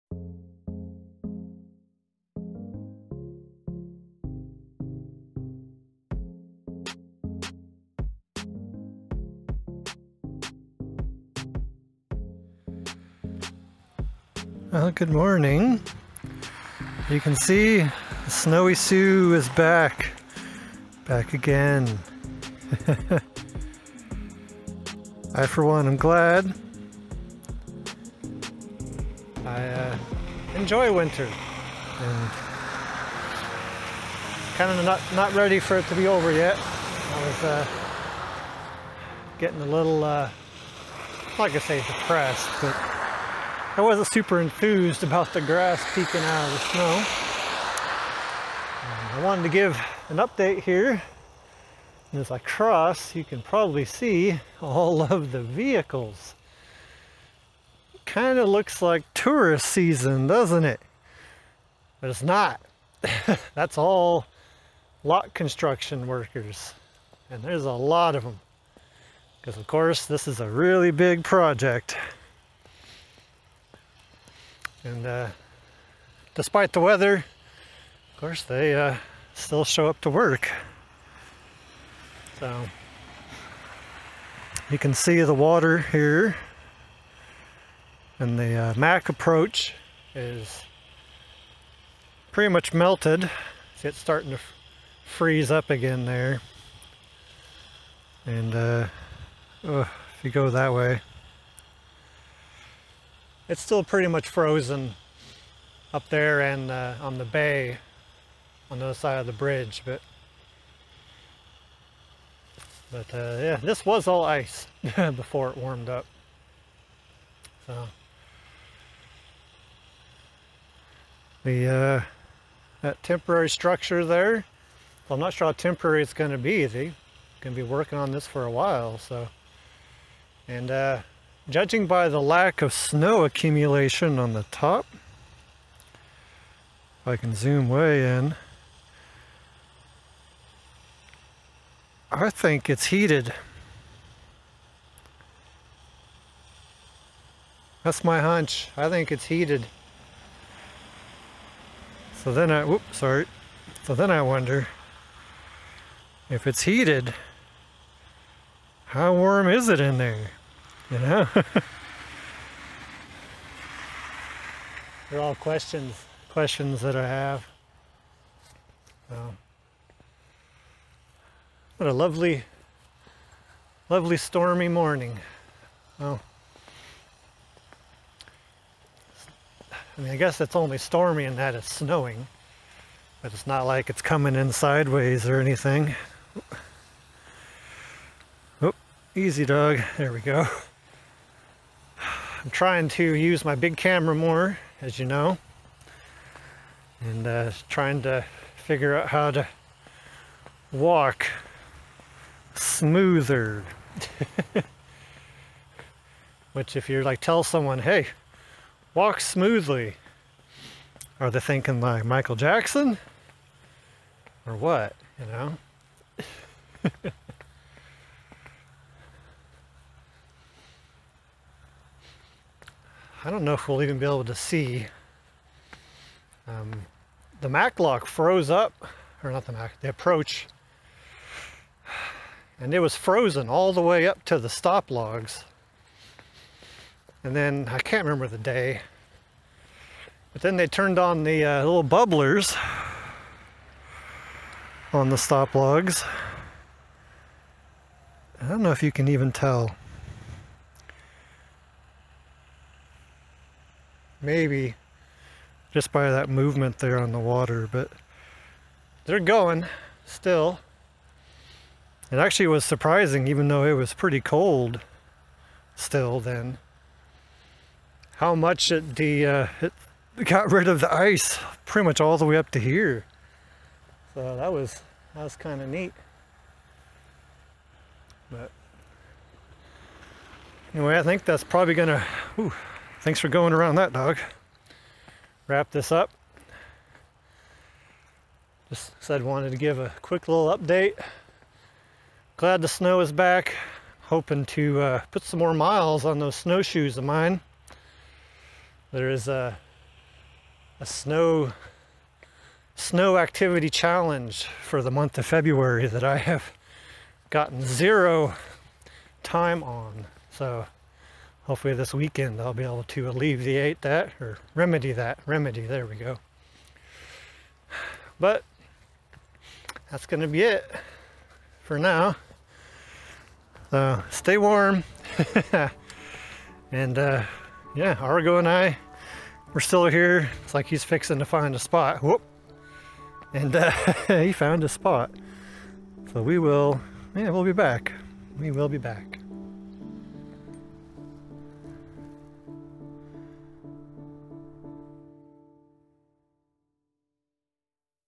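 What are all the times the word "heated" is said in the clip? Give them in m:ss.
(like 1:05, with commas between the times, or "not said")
2:22, 2:29, 2:36.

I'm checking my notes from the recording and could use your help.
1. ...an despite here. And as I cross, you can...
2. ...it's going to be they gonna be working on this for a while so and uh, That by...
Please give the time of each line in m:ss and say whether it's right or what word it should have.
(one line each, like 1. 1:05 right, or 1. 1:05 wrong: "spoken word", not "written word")
1. 0:50 wrong: "update", not "despite"
2. 2:06 wrong: "Judging", not "That".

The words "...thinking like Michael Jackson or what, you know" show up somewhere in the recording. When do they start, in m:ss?
3:31.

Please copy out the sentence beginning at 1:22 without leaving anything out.
So you can see the water here.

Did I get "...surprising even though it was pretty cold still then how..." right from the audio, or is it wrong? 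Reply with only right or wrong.
right.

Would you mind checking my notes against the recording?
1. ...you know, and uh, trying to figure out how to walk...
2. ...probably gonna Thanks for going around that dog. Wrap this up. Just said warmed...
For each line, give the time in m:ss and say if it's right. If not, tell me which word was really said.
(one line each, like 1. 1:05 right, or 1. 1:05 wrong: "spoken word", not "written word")
1. 3:14 right
2. 4:41 wrong: "wanted", not "warmed".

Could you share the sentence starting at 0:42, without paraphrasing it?
But I wasn't super enthused about the grass peeking out of the snow.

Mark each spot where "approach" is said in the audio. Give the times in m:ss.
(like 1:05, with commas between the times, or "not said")
1:29, 3:49.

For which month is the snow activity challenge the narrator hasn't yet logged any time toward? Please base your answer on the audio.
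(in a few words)
February.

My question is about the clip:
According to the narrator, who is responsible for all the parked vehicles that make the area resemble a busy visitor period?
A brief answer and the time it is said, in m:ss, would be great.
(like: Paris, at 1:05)
Construction workers, at 1:05.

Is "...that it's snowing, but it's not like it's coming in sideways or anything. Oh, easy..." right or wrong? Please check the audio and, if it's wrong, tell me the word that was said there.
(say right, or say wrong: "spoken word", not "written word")
right.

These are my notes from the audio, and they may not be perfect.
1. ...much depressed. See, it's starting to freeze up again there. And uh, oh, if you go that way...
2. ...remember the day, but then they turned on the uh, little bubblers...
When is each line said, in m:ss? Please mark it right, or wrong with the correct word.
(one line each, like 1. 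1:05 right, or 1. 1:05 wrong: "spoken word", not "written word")
1. 1:32 wrong: "melted", not "depressed"
2. 3:58 right.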